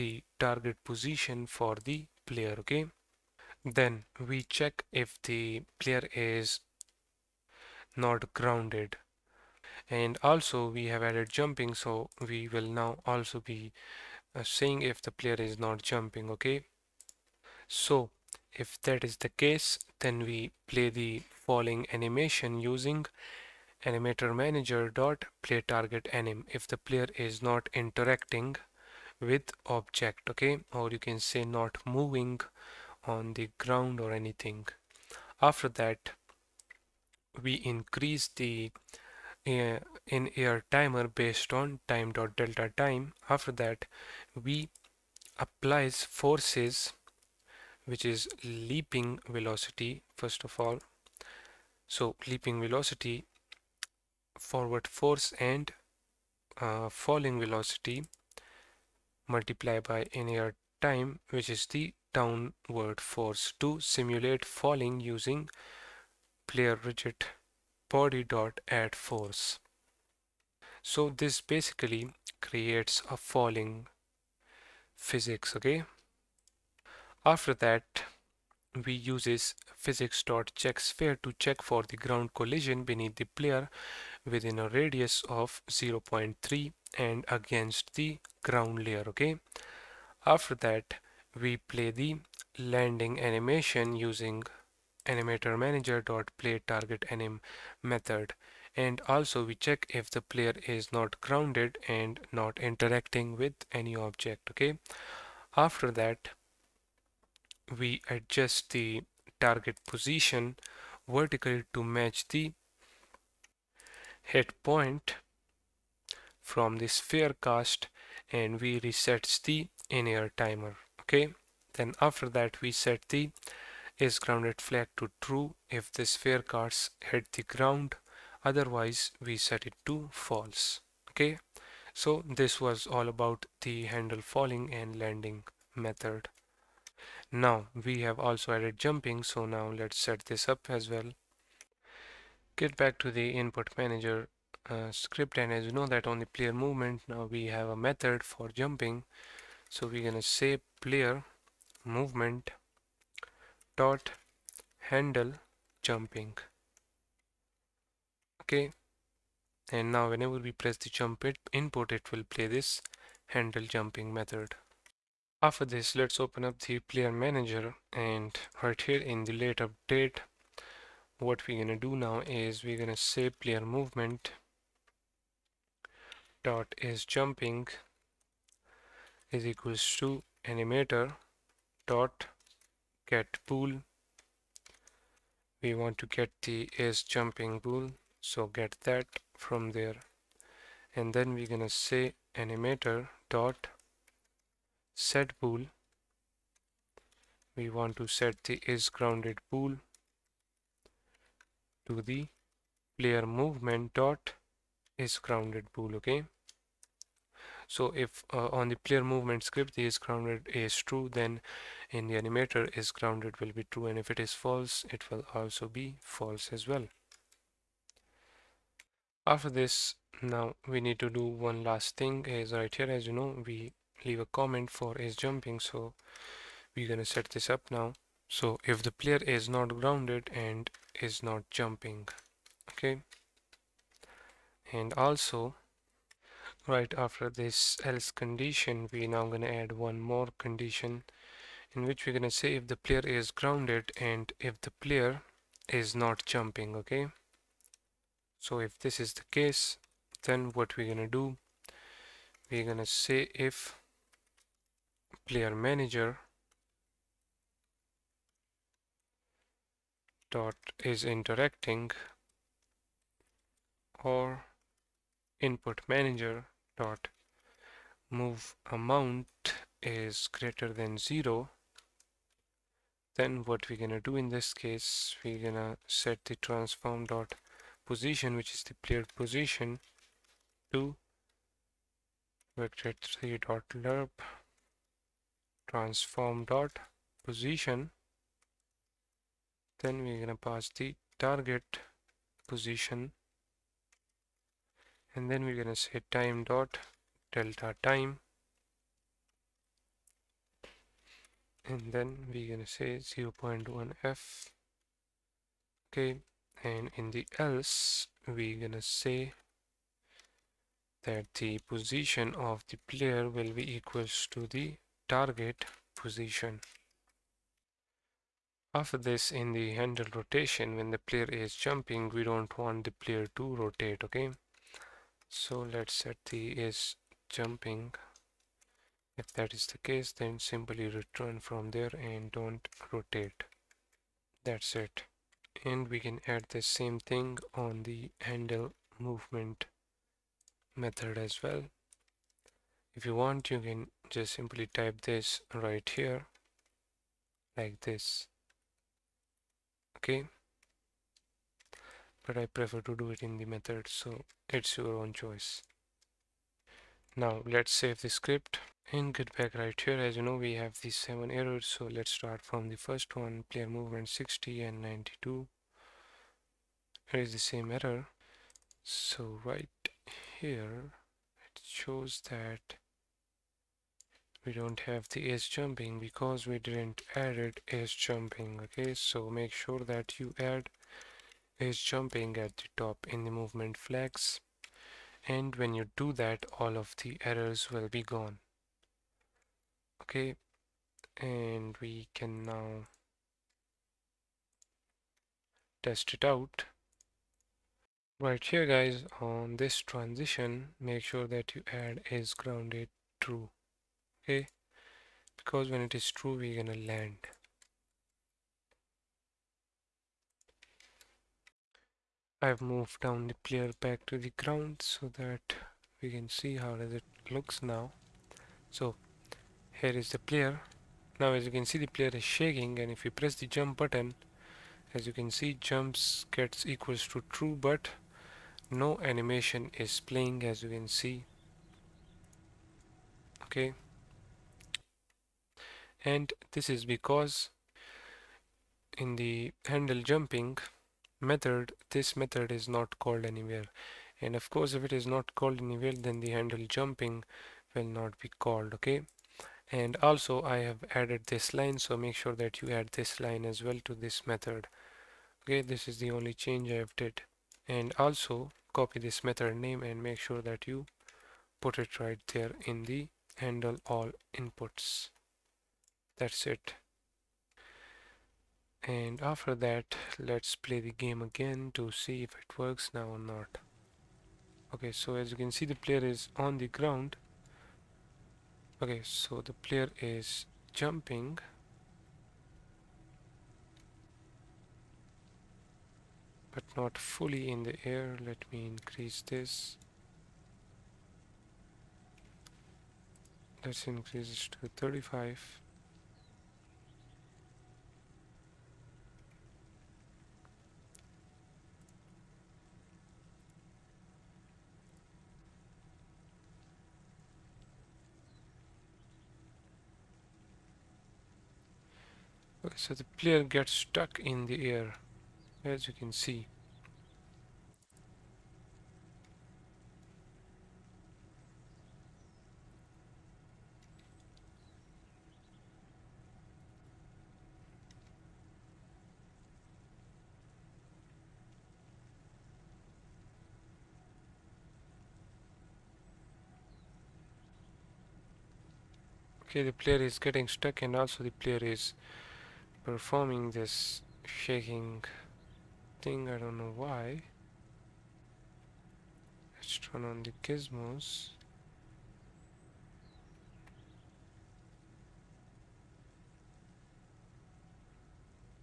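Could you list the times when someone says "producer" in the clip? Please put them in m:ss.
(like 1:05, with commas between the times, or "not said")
not said.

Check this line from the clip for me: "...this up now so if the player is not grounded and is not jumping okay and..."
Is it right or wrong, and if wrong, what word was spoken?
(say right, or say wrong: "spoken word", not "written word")
right.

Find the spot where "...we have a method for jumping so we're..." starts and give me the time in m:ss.
2:27.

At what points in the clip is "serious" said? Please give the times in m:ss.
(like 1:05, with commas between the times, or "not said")
not said.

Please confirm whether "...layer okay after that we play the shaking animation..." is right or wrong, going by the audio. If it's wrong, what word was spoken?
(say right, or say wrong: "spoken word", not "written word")
wrong: "landing", not "shaking".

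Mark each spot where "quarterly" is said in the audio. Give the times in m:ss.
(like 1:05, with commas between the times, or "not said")
not said.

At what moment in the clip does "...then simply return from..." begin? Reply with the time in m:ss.
5:30.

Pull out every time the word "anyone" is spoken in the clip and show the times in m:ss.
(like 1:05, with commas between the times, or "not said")
not said.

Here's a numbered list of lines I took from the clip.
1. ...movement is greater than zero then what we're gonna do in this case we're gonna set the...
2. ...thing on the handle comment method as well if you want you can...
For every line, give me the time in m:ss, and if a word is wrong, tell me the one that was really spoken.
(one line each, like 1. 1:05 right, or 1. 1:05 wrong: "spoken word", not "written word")
1. 4:28 wrong: "amount", not "movement"
2. 5:36 wrong: "movement", not "comment".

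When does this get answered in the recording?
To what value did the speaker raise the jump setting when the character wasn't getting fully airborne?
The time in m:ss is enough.
8:14.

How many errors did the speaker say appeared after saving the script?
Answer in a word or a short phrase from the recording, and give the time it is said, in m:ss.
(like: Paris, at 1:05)
7, at 6:00.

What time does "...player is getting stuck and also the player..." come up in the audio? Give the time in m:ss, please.
8:59.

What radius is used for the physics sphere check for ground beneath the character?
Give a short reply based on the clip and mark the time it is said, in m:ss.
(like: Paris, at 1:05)
0.3, at 1:25.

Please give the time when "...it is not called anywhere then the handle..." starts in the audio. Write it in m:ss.
7:24.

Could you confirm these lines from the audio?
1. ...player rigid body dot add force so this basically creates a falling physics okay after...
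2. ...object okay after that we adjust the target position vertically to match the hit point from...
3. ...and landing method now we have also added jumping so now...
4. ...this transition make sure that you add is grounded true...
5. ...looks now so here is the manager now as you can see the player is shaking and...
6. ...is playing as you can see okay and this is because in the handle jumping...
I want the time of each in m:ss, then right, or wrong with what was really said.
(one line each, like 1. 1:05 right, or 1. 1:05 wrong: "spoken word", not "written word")
1. 1:06 right
2. 1:43 right
3. 2:14 right
4. 6:39 right
5. 6:57 wrong: "player", not "manager"
6. 7:09 right.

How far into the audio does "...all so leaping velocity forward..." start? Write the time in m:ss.
0:50.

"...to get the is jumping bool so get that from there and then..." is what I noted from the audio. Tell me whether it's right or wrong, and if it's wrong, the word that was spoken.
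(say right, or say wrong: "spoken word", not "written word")
right.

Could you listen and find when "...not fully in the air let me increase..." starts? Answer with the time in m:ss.
8:06.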